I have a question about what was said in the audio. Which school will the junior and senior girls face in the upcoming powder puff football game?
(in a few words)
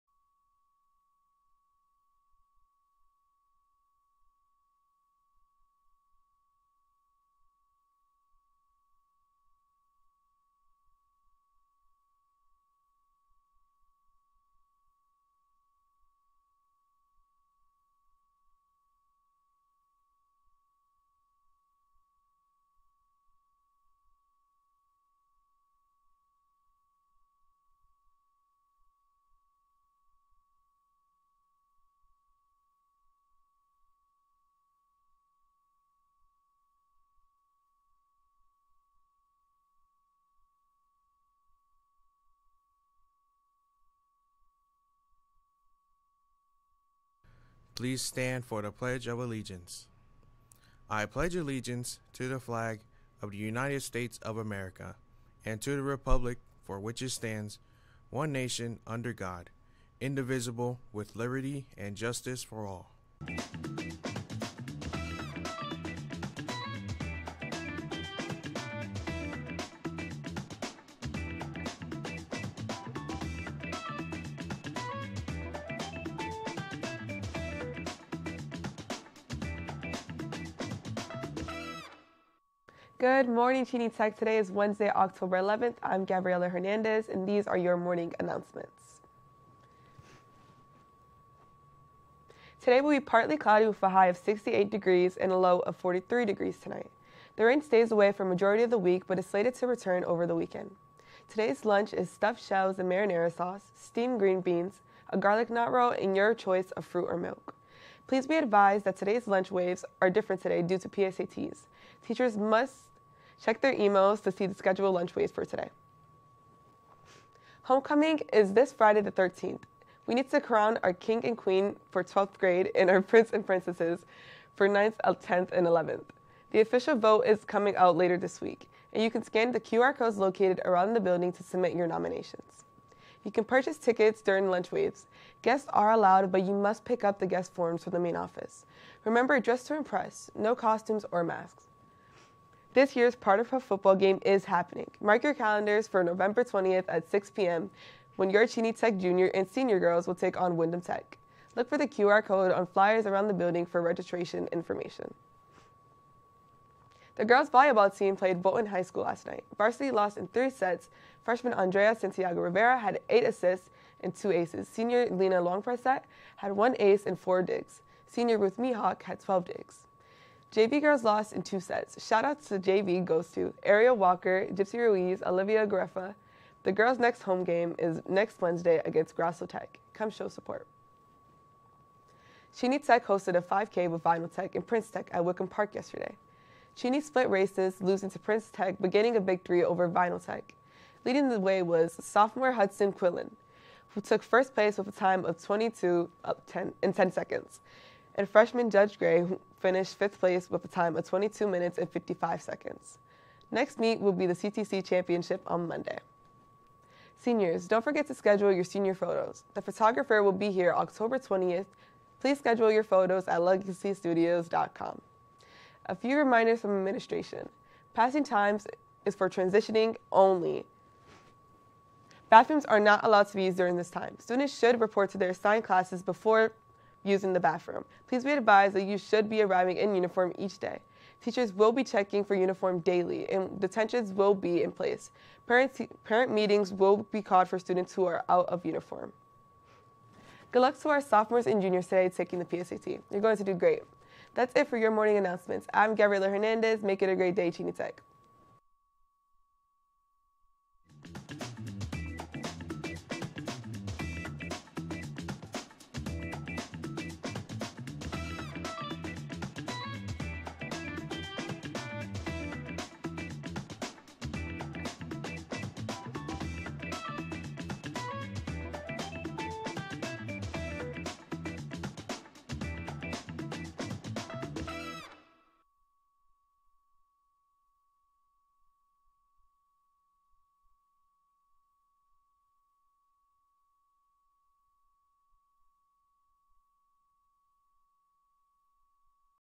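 Windham Tech.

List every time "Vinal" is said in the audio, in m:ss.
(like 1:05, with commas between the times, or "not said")
3:04, 3:09.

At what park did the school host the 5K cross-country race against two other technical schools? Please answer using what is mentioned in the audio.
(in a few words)
Wickham Park.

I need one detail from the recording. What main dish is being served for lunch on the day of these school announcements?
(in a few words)
Stuffed shells.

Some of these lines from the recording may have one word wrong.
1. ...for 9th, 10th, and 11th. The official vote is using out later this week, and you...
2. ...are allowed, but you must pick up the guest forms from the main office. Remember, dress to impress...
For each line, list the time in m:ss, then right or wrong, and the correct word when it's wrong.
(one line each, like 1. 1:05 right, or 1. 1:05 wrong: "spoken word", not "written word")
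1. 2:04 wrong: "coming", not "using"
2. 2:15 right.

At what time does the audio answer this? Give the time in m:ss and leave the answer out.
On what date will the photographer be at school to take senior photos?
3:30.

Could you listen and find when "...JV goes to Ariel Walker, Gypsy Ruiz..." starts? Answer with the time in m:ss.
2:52.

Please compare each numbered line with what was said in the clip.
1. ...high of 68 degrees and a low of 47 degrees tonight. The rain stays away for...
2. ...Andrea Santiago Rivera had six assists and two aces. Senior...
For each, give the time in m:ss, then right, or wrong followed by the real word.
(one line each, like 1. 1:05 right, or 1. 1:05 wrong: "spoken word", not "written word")
1. 1:33 wrong: "43", not "47"
2. 2:41 wrong: "eight", not "six".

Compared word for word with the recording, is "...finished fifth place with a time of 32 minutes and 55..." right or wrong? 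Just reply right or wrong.
wrong.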